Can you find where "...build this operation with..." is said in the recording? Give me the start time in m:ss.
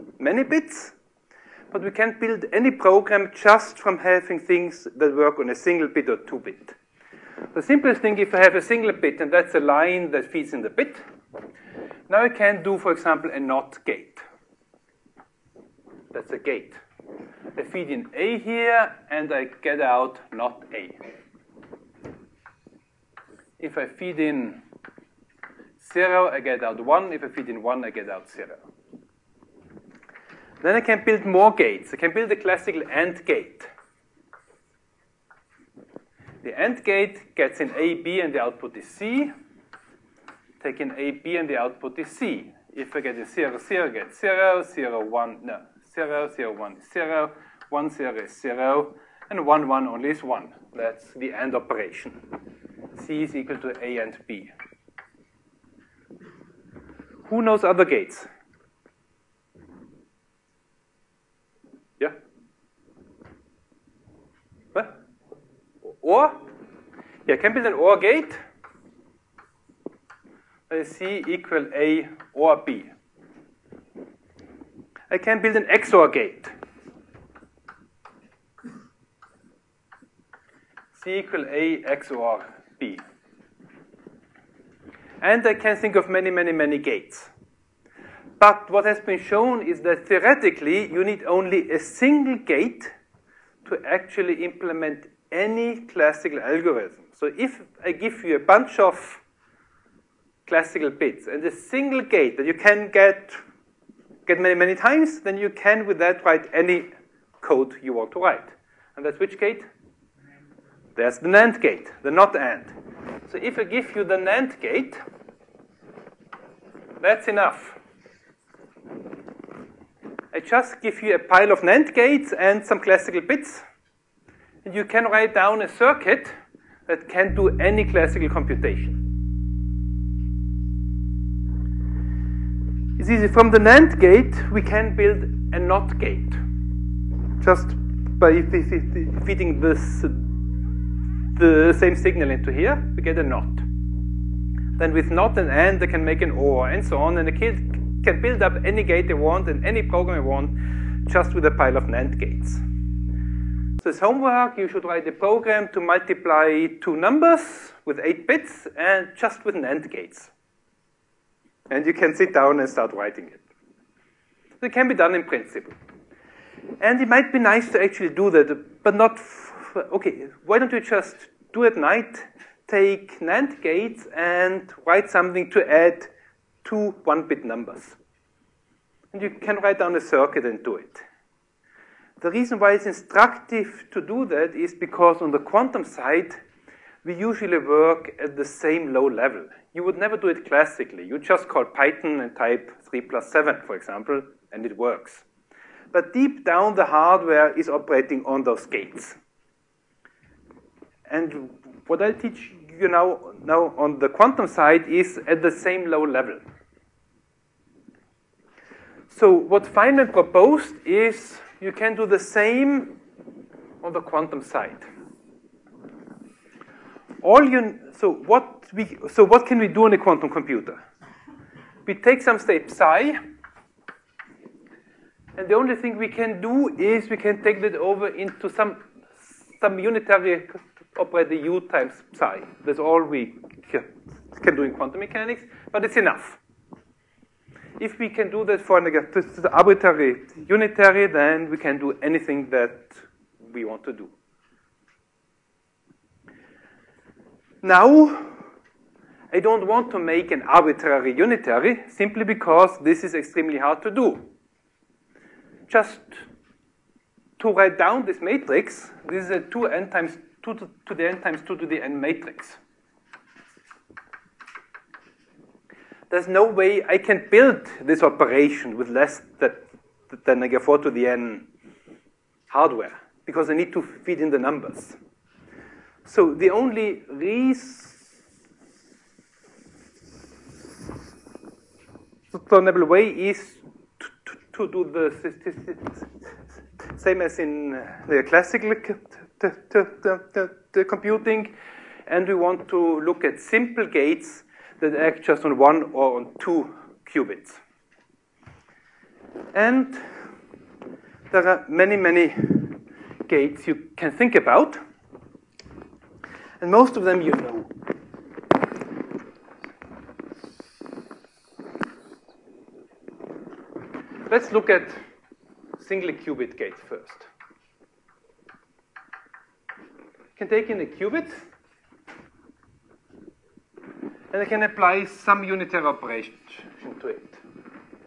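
4:27.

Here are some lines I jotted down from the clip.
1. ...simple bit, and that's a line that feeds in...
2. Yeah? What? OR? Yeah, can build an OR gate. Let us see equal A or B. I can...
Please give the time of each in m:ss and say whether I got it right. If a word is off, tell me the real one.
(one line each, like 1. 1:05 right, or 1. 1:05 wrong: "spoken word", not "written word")
1. 0:08 wrong: "single", not "simple"
2. 1:01 right.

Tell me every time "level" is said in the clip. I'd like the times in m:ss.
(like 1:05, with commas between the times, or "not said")
3:09, 3:26.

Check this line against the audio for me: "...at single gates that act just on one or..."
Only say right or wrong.
wrong.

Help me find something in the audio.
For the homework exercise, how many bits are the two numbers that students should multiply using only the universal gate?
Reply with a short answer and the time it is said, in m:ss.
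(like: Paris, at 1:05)
8, at 2:37.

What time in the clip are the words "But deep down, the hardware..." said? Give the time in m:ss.
3:15.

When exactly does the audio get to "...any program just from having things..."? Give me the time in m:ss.
0:02.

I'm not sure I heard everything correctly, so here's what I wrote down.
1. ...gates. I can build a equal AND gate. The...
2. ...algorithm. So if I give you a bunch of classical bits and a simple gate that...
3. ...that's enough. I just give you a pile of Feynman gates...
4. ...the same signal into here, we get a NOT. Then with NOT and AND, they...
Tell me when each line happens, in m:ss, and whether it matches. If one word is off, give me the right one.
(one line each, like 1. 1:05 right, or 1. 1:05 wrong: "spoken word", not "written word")
1. 0:31 wrong: "classical", not "equal"
2. 1:36 wrong: "single", not "simple"
3. 1:57 wrong: "NAND", not "Feynman"
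4. 2:21 right.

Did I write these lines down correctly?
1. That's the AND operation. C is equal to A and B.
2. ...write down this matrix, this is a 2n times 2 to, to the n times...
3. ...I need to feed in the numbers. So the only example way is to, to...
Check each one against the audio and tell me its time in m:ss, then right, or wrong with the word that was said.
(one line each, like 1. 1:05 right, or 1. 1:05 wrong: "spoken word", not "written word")
1. 0:50 right
2. 4:17 right
3. 4:33 wrong: "reasonable", not "example".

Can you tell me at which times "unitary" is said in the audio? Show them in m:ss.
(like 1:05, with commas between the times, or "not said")
3:49, 4:00, 4:11, 5:25.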